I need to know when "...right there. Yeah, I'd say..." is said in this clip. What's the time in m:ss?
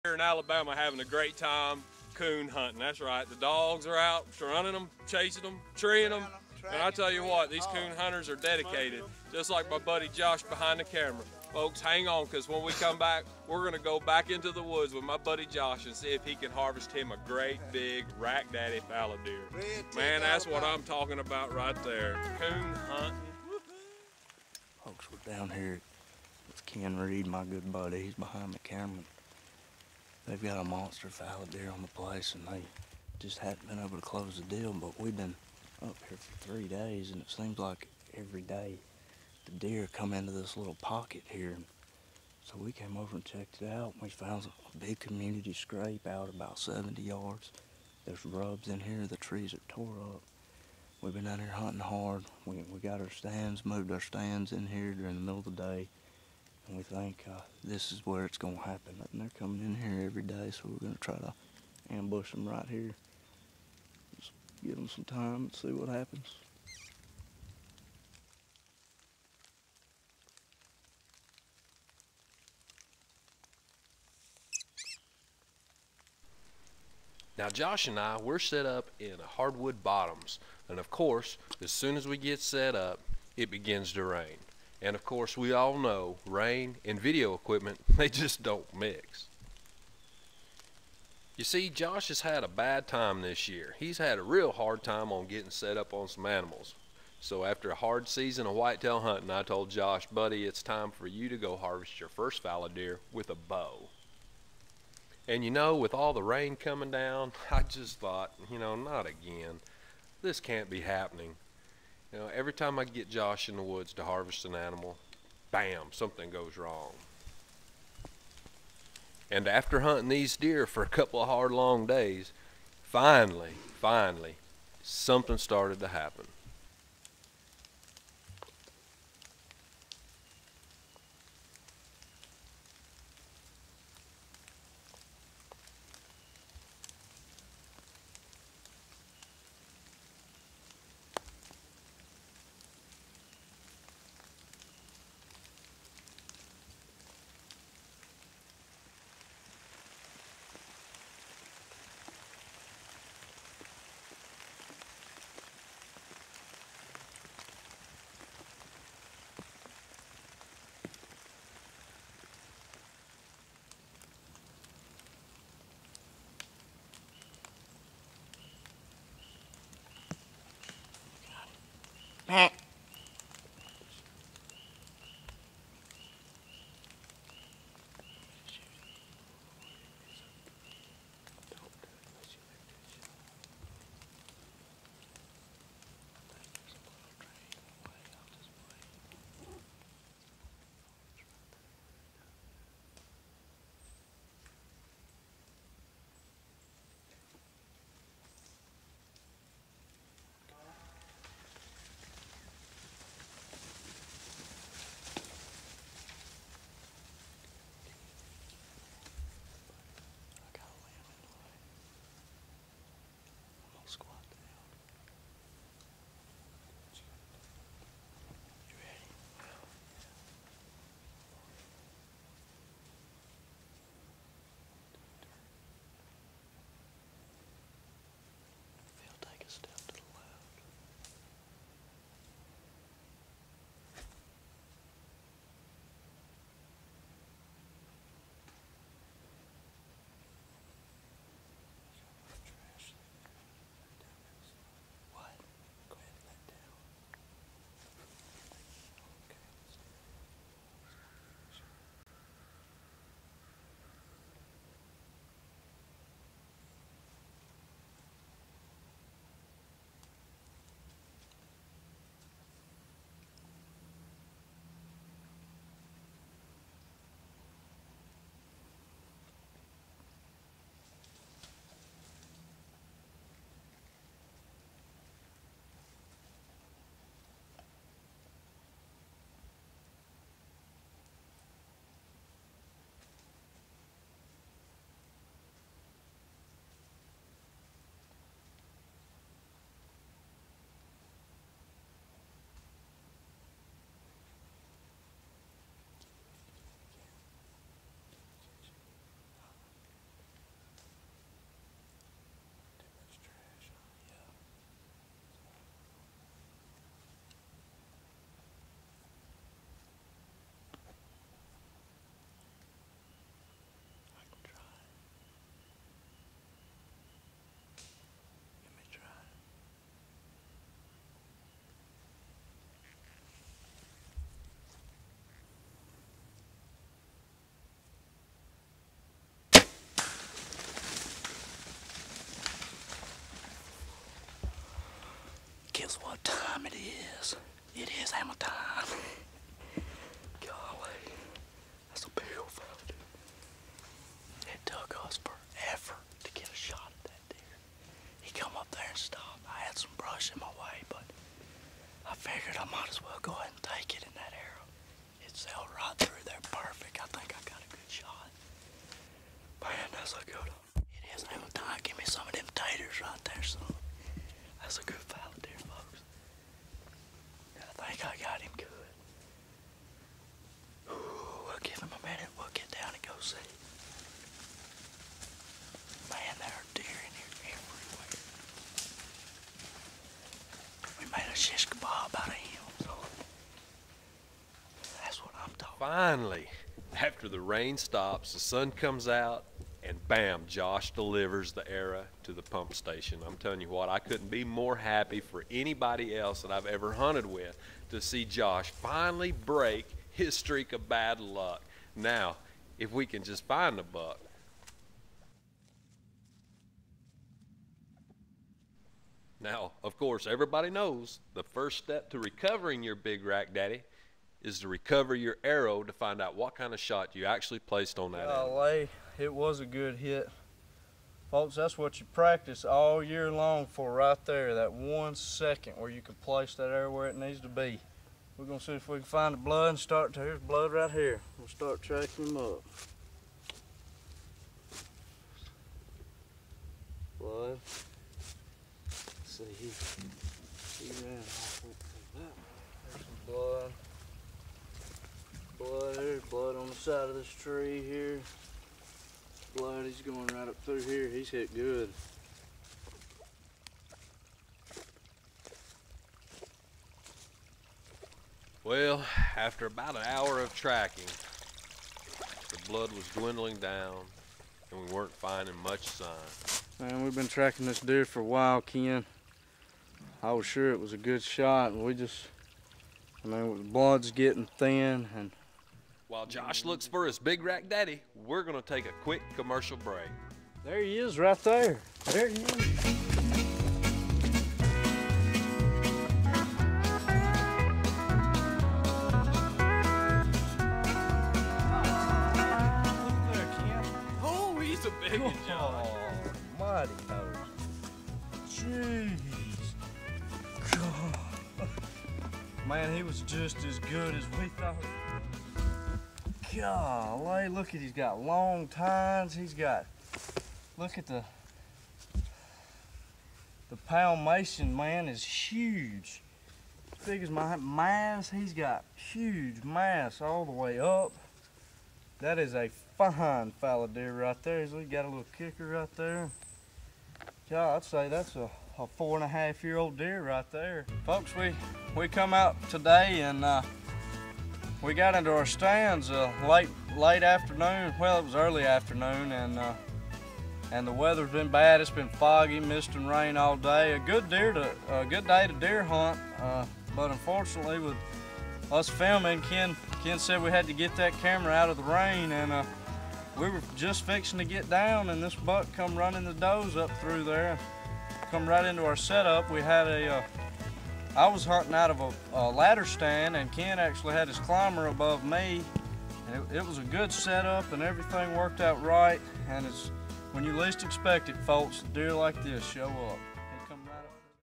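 8:45.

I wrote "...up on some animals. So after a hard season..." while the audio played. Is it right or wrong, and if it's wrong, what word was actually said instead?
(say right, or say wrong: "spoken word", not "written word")
right.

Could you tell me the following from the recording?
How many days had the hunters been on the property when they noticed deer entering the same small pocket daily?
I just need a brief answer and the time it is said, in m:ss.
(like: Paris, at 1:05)
3, at 0:36.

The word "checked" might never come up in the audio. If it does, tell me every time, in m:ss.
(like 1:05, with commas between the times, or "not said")
0:43.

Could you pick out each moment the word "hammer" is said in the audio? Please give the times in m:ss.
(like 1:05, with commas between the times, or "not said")
5:38, 6:01.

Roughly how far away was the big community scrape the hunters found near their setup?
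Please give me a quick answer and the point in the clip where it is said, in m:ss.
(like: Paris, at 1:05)
70 yards, at 0:46.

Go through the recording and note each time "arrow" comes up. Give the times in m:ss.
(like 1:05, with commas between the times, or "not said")
5:54, 6:55.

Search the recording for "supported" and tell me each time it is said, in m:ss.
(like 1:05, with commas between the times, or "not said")
not said.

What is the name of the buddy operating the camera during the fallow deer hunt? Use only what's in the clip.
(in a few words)
Ken Reed.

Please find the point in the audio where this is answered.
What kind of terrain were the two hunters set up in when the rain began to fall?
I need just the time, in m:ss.
1:19.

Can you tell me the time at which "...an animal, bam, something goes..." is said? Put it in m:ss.
1:54.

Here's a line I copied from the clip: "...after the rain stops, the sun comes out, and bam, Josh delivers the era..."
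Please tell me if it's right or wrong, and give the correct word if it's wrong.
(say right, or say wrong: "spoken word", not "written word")
right.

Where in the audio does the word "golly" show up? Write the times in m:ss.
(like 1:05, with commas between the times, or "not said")
5:40, 6:58, 8:26.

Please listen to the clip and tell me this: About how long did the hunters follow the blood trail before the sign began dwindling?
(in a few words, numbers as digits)
About an hour.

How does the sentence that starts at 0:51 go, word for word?
We've been out here hunting hard.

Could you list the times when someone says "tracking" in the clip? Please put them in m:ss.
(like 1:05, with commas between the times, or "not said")
7:11, 7:40, 7:47.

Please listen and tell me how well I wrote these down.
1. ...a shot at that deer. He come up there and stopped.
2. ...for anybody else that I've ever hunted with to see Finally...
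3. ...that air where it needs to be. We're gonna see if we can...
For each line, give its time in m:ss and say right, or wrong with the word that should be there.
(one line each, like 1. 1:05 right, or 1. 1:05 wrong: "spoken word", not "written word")
1. 5:46 right
2. 6:35 wrong: "Josh", not "Finally"
3. 7:06 right.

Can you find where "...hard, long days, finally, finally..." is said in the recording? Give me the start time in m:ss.
2:01.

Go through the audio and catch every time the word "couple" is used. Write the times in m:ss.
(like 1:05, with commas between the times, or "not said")
2:00.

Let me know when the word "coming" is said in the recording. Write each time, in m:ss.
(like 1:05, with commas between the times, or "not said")
0:59, 1:46.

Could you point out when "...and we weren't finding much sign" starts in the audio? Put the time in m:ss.
7:44.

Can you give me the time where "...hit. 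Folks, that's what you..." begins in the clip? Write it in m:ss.
6:59.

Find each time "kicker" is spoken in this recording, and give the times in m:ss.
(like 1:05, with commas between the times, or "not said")
8:45.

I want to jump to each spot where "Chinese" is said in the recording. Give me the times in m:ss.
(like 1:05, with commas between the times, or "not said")
not said.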